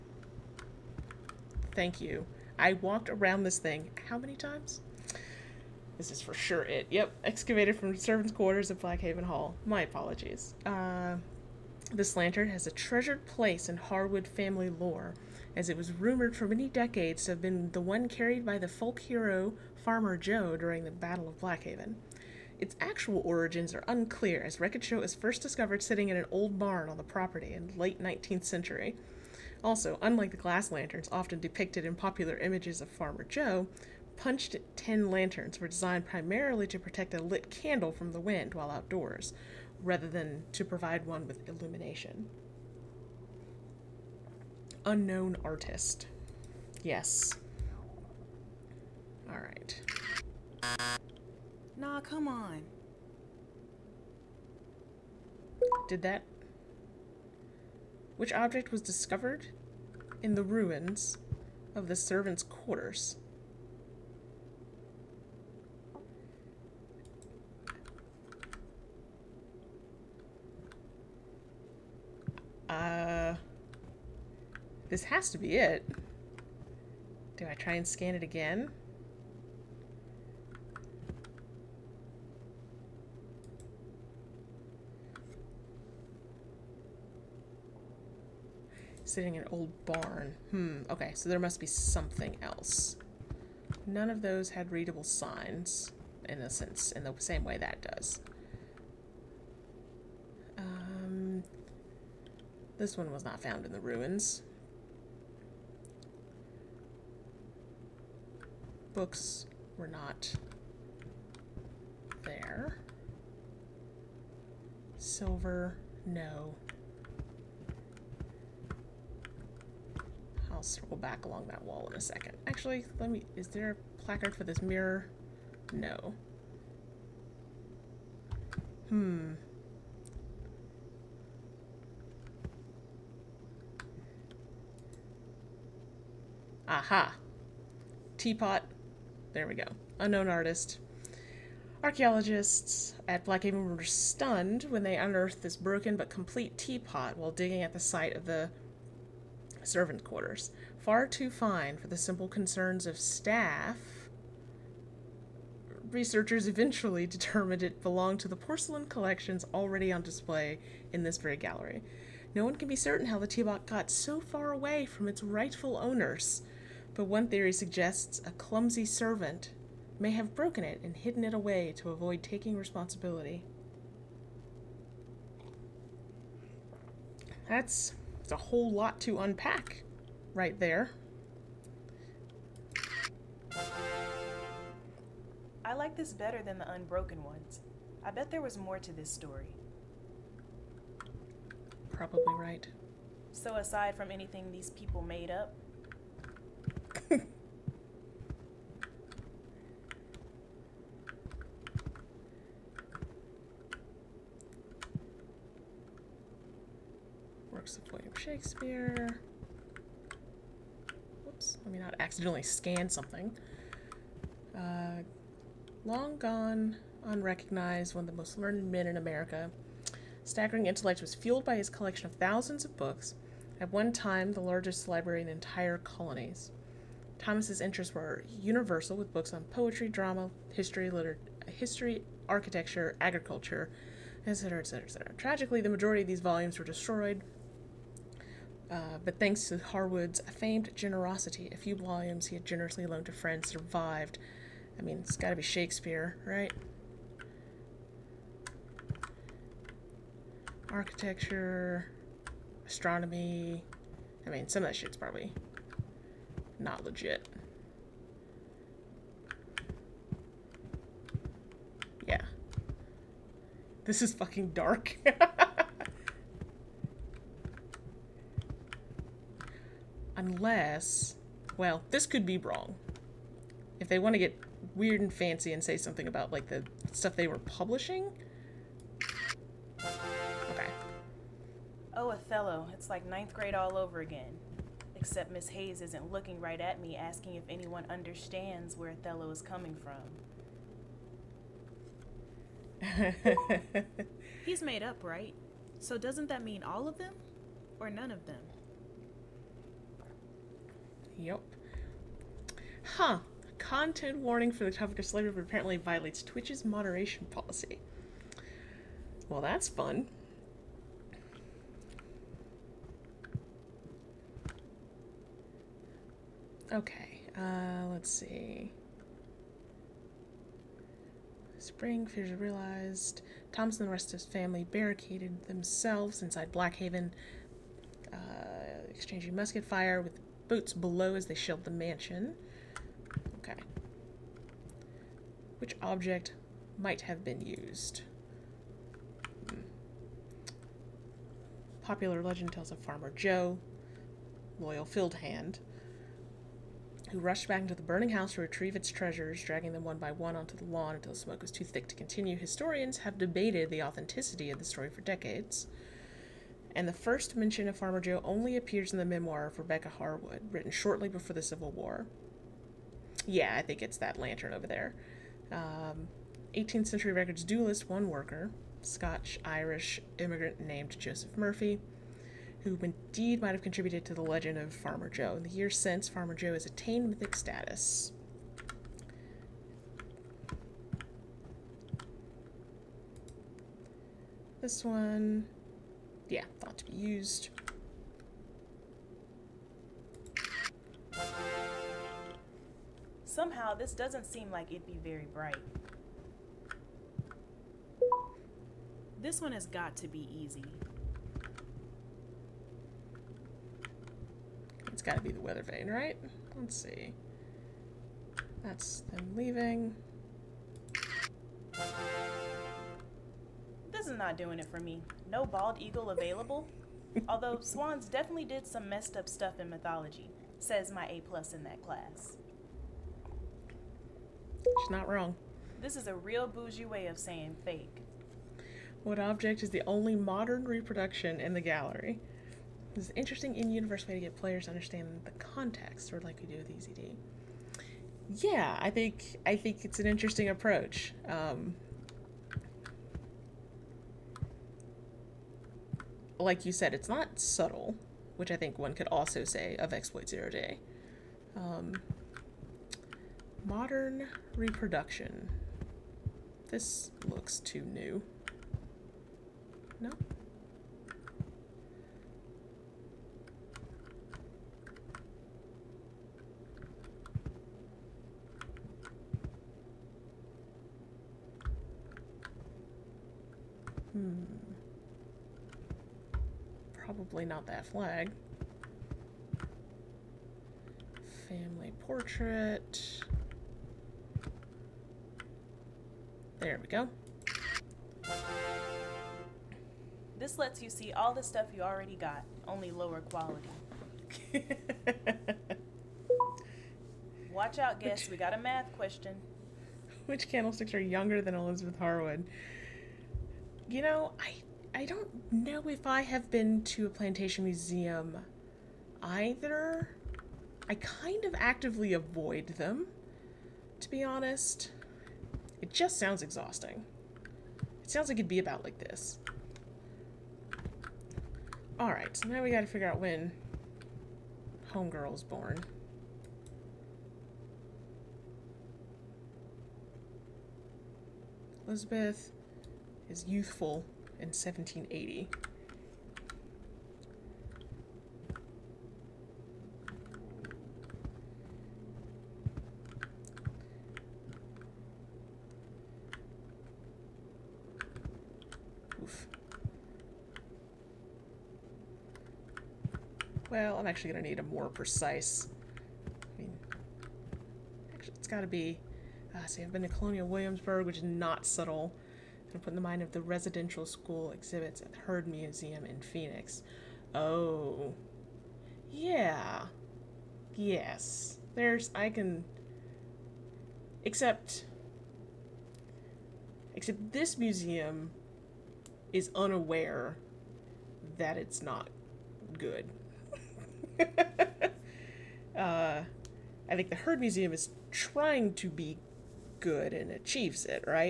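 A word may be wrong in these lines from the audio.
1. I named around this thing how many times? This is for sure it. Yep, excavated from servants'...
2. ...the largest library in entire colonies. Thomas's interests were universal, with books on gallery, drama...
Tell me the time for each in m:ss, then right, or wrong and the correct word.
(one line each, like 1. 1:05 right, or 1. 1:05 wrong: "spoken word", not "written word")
1. 0:02 wrong: "walked", not "named"
2. 3:44 wrong: "poetry", not "gallery".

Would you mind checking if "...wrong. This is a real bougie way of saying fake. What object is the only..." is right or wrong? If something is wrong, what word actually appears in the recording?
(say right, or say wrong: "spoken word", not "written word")
right.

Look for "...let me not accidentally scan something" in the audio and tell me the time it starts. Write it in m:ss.
3:31.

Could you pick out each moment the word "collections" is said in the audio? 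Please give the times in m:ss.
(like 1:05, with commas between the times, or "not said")
2:38, 3:41.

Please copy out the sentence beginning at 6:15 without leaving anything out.
In the years since, Farmer Joe has attained mythic status.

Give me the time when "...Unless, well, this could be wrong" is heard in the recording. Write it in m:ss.
4:30.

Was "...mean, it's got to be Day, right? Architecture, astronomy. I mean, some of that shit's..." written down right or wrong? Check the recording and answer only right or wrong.
wrong.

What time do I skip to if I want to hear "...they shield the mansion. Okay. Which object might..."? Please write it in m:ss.
5:31.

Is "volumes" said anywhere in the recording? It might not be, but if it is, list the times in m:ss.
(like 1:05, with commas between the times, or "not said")
3:56, 4:01.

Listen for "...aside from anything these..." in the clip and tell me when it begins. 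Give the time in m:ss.
3:13.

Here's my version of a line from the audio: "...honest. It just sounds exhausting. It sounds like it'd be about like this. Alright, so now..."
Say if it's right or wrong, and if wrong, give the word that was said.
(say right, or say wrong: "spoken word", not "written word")
right.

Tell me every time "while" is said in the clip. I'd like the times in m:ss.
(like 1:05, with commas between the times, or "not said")
0:38, 2:27.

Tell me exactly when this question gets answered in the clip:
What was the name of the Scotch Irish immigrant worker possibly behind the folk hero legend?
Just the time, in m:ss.
6:10.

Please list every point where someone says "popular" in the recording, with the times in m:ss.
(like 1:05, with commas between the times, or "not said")
0:31, 5:41.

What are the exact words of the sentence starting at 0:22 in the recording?
Its actual origins are unclear, as it was first discovered sitting in an old barn on the property in late 19th century.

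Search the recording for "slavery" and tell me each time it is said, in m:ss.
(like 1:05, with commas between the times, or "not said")
5:05.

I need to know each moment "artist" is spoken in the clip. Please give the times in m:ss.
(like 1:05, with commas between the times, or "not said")
0:45, 2:20.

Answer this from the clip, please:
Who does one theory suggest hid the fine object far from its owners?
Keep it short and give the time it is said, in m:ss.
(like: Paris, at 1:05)
A clumsy servant, at 2:48.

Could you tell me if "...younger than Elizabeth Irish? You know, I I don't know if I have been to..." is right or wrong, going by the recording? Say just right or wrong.
wrong.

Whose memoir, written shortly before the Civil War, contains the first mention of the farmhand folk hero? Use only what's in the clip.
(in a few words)
Rebecca Harwood.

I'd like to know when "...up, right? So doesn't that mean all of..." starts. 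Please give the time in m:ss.
4:54.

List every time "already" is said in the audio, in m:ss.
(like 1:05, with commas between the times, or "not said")
2:39, 8:11.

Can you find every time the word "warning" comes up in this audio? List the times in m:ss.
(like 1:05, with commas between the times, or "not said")
5:04.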